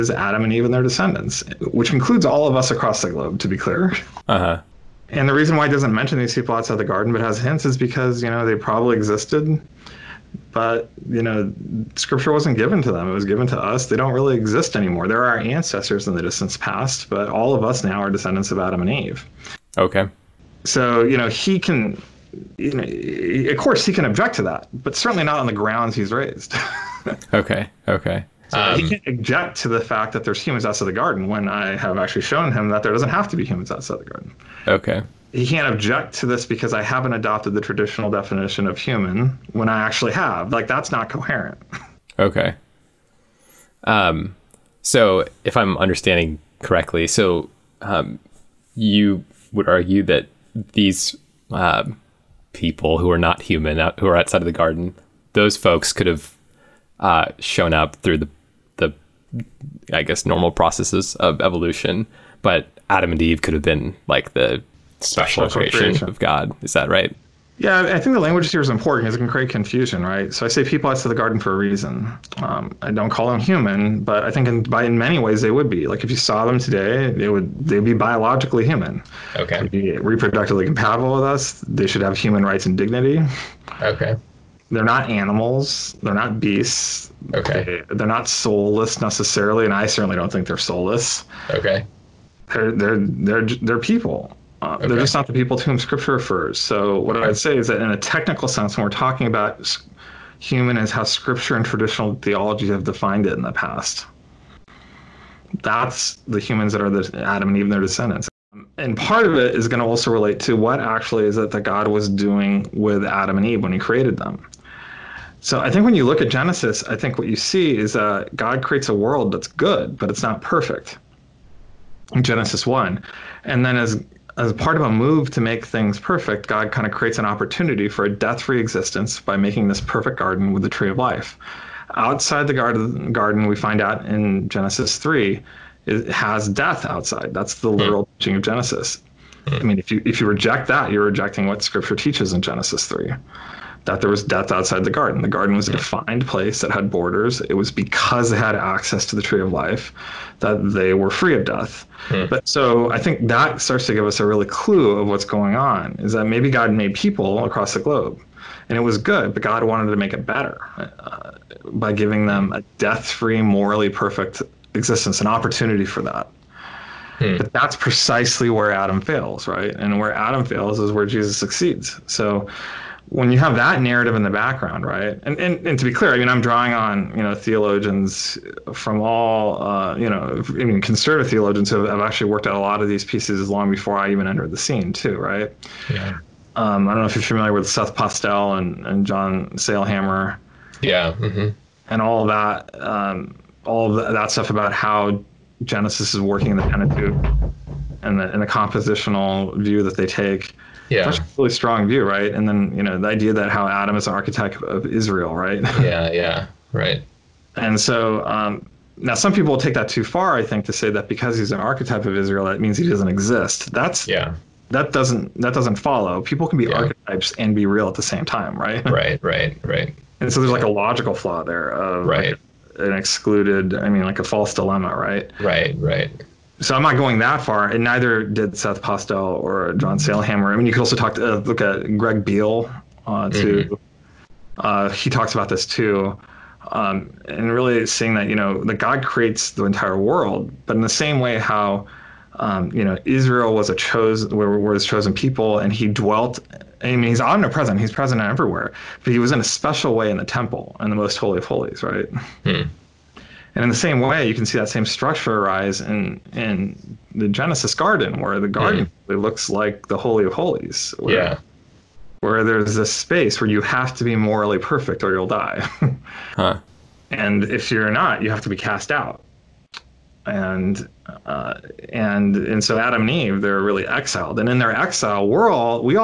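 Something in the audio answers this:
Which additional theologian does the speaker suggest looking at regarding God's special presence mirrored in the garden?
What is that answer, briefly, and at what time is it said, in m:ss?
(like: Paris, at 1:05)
Greg Beale, at 3:51.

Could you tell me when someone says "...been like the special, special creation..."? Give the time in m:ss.
1:03.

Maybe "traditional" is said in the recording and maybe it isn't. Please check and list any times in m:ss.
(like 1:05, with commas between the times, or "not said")
0:37, 1:41.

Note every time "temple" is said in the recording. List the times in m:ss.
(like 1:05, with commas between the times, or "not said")
4:10.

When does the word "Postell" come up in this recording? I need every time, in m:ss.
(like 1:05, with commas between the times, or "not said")
3:07, 3:48.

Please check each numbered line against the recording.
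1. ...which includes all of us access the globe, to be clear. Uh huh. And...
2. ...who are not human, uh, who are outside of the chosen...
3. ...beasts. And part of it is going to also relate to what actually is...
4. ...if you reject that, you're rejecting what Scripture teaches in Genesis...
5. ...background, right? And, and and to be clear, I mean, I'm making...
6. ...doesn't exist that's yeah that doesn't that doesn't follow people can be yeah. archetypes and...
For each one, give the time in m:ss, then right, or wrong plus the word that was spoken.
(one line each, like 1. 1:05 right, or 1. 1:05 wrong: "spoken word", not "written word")
1. 0:01 wrong: "across", not "access"
2. 0:52 wrong: "garden", not "chosen"
3. 1:47 wrong: "descendants", not "beasts"
4. 2:20 right
5. 2:54 wrong: "drawing", not "making"
6. 3:32 right.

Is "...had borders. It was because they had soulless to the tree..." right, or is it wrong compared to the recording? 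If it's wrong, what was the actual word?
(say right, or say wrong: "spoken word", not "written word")
wrong: "access", not "soulless".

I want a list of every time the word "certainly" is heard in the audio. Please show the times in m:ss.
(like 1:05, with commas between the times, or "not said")
0:24, 1:29.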